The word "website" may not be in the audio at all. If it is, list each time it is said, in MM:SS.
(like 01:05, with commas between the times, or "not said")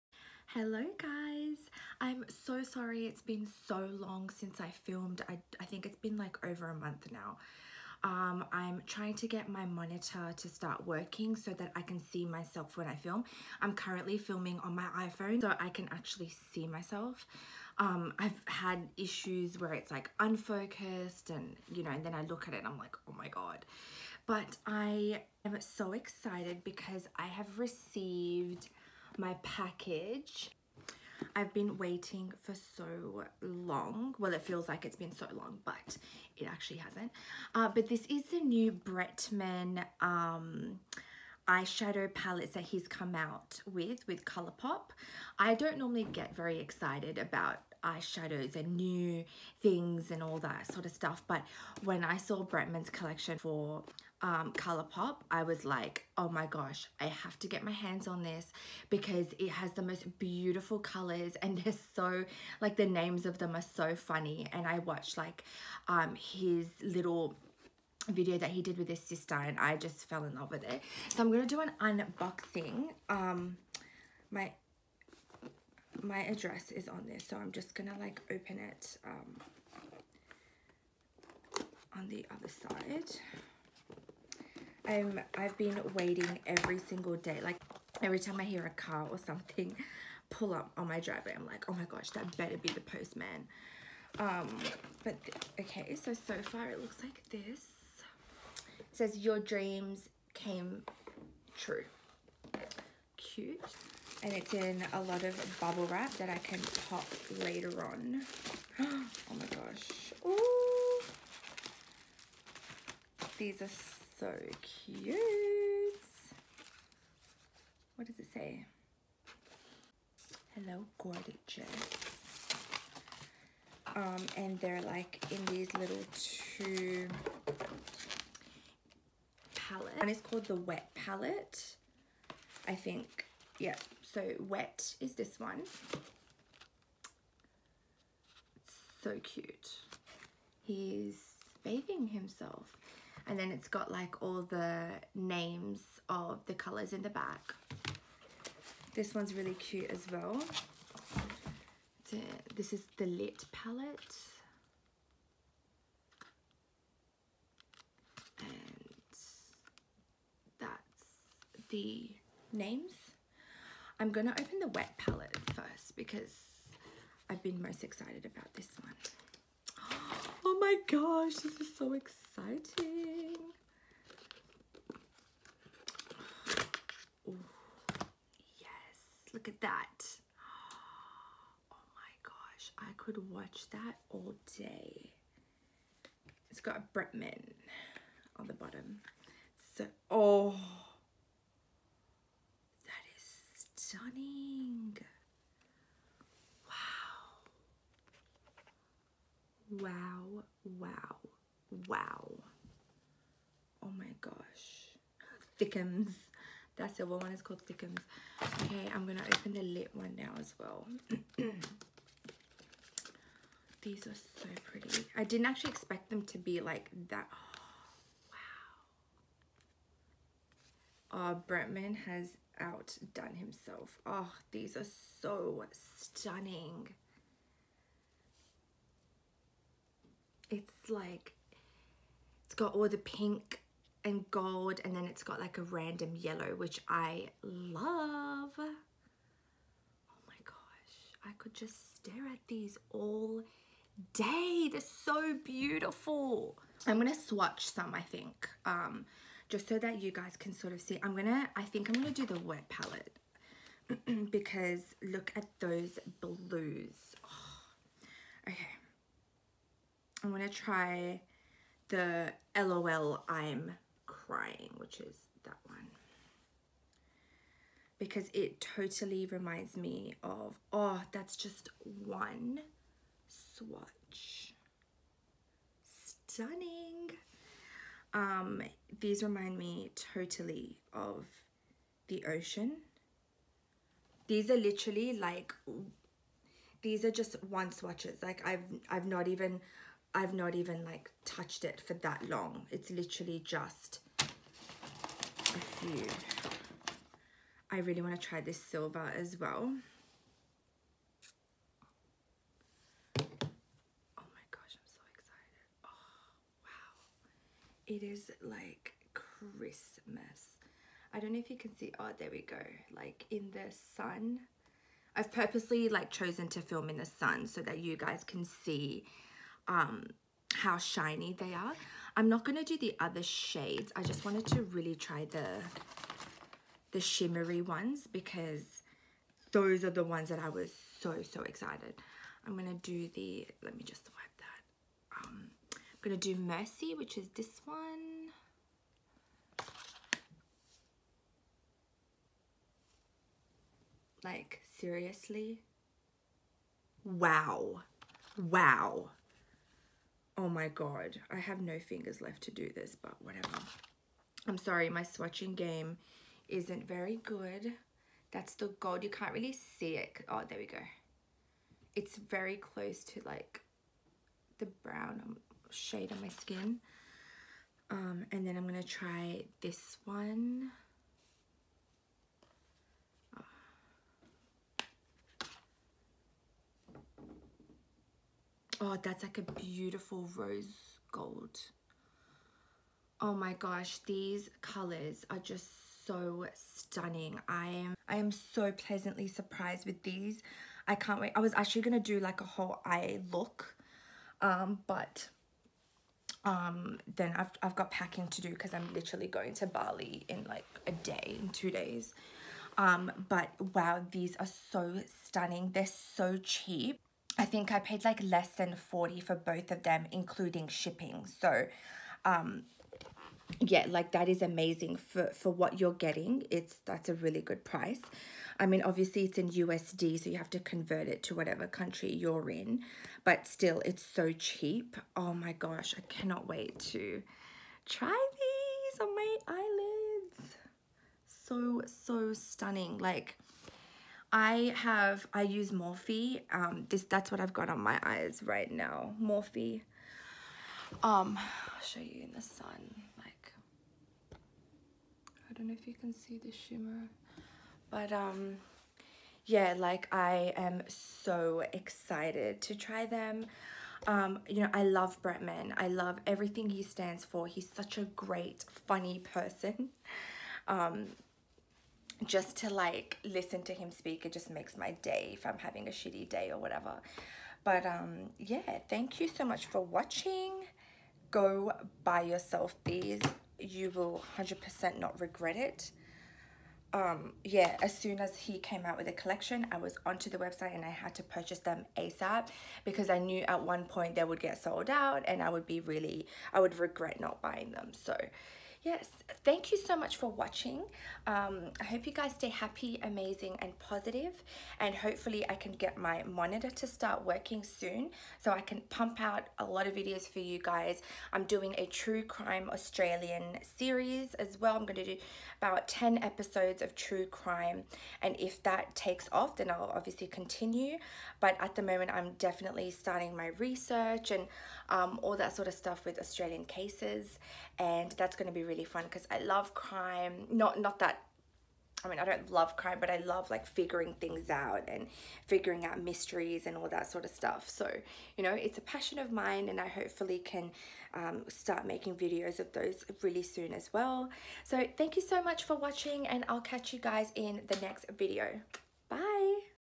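08:00.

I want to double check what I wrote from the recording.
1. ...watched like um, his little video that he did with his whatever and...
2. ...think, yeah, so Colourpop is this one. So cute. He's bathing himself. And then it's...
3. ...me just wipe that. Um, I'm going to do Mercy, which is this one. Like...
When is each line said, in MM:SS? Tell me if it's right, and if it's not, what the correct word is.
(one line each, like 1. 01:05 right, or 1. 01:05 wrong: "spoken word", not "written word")
1. 01:04 wrong: "sister", not "whatever"
2. 02:12 wrong: "Wet", not "Colourpop"
3. 05:33 right.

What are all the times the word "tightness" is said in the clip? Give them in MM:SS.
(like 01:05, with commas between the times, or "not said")
not said.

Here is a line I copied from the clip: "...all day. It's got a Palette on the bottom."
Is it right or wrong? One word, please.
wrong.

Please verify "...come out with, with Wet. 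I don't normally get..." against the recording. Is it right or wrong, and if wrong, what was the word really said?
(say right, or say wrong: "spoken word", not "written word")
wrong: "Colourpop", not "Wet".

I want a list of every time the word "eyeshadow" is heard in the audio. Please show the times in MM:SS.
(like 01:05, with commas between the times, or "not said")
00:41, 00:47.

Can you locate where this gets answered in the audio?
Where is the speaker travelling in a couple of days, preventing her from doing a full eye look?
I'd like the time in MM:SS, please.
06:39.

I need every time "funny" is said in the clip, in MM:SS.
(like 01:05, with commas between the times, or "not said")
01:03, 07:38.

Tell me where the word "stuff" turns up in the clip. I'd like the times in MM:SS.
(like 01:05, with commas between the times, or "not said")
00:50, 08:35, 08:47.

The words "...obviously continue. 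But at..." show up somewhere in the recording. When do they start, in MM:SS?
08:29.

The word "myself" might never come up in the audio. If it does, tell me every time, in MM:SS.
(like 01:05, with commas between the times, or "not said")
00:12, 00:16.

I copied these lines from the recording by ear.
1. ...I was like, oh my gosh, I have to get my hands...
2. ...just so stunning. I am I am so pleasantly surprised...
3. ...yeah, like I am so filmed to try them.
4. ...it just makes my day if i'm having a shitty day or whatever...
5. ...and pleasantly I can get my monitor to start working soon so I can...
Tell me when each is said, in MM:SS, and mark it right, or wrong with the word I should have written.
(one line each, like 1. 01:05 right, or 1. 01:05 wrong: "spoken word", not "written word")
1. 00:55 right
2. 06:25 right
3. 07:29 wrong: "excited", not "filmed"
4. 07:44 right
5. 08:14 wrong: "hopefully", not "pleasantly".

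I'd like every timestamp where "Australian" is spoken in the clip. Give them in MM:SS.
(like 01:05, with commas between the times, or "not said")
08:22, 08:36.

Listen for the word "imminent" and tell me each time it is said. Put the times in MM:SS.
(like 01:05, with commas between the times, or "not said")
not said.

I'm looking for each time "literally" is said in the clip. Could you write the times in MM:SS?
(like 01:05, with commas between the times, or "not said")
04:44, 04:52, 06:38.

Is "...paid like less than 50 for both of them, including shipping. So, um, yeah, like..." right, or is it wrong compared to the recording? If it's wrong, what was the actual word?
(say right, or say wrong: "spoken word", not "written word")
wrong: "40", not "50".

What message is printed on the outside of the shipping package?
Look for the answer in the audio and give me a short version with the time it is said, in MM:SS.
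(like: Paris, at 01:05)
your dreams came true, at 01:39.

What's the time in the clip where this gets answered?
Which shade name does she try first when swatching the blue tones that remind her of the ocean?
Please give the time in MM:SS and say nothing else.
04:22.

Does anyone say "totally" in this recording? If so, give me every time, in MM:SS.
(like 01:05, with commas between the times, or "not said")
04:28, 04:40.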